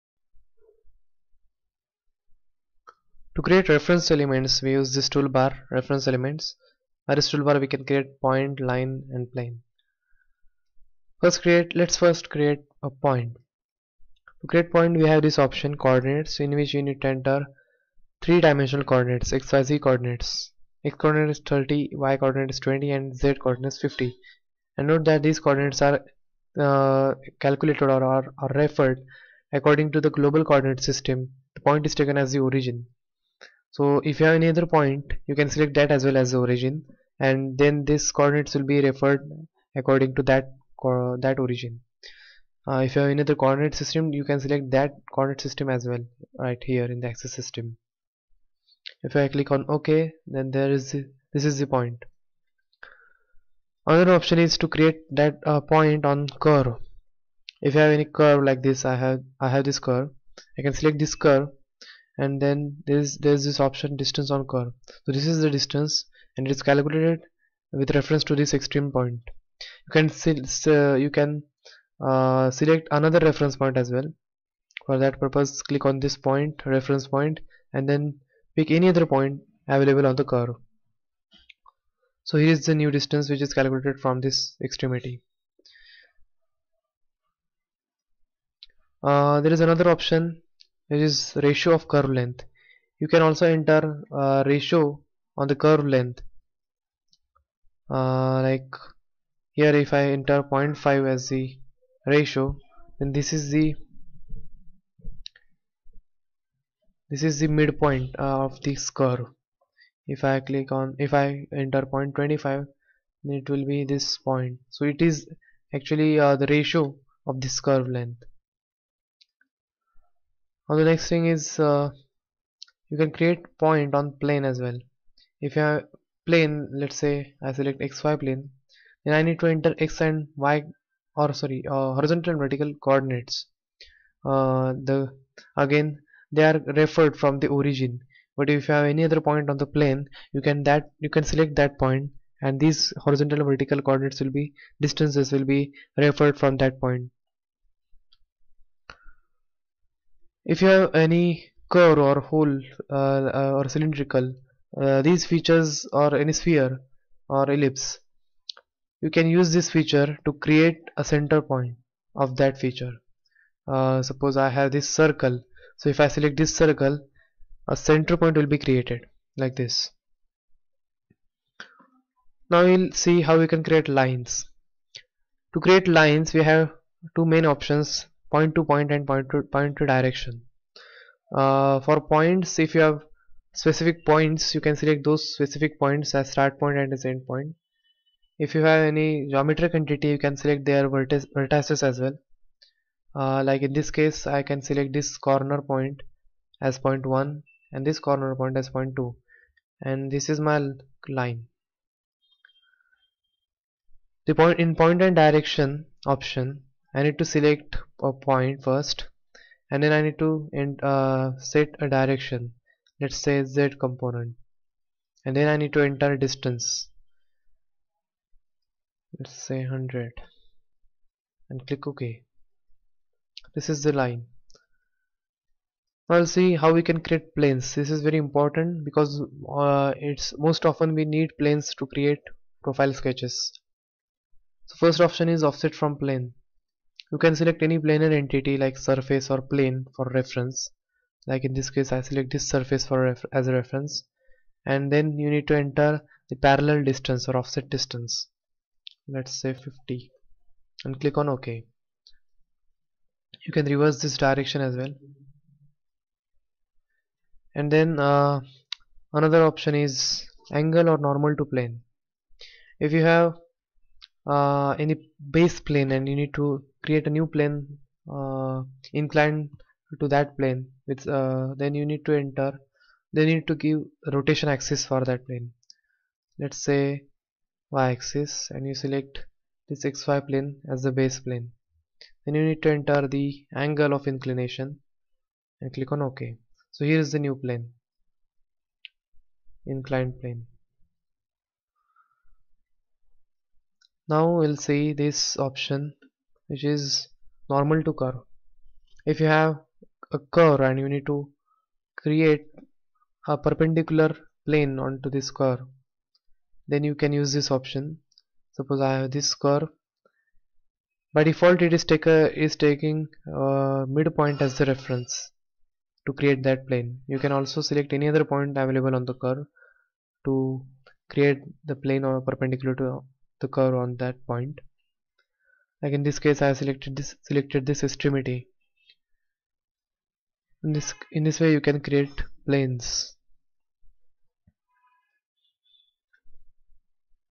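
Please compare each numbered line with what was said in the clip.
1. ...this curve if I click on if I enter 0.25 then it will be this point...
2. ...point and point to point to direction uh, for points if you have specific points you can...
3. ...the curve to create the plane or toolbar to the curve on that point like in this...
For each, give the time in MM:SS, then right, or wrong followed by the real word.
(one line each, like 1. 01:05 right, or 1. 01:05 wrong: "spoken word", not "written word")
1. 01:48 right
2. 02:58 right
3. 05:19 wrong: "perpendicular", not "toolbar".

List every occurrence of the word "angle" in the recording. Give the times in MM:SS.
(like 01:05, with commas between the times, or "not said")
04:20, 04:43.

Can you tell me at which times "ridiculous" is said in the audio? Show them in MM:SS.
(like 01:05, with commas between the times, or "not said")
not said.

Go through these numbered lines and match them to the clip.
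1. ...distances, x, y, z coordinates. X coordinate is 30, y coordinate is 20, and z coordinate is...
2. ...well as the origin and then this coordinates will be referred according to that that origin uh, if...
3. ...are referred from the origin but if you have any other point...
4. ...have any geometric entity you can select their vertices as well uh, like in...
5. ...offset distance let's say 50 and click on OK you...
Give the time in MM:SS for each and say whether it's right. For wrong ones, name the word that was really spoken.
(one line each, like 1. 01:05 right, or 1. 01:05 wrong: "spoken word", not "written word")
1. 00:18 wrong: "coordinates", not "distances"
2. 00:36 right
3. 02:16 right
4. 03:08 right
5. 04:07 right.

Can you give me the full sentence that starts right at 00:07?
By this toolbar, we can create point, line, and plane.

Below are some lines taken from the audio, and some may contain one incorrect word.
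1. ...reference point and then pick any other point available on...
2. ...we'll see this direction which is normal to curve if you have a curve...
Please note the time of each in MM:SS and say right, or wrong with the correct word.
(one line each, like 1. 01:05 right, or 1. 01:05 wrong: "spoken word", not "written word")
1. 01:16 right
2. 04:54 wrong: "option", not "direction".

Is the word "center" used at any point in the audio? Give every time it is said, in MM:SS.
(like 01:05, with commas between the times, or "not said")
02:41, 02:47.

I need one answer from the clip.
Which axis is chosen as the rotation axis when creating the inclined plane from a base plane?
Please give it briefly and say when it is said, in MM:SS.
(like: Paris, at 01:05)
y axis, at 04:37.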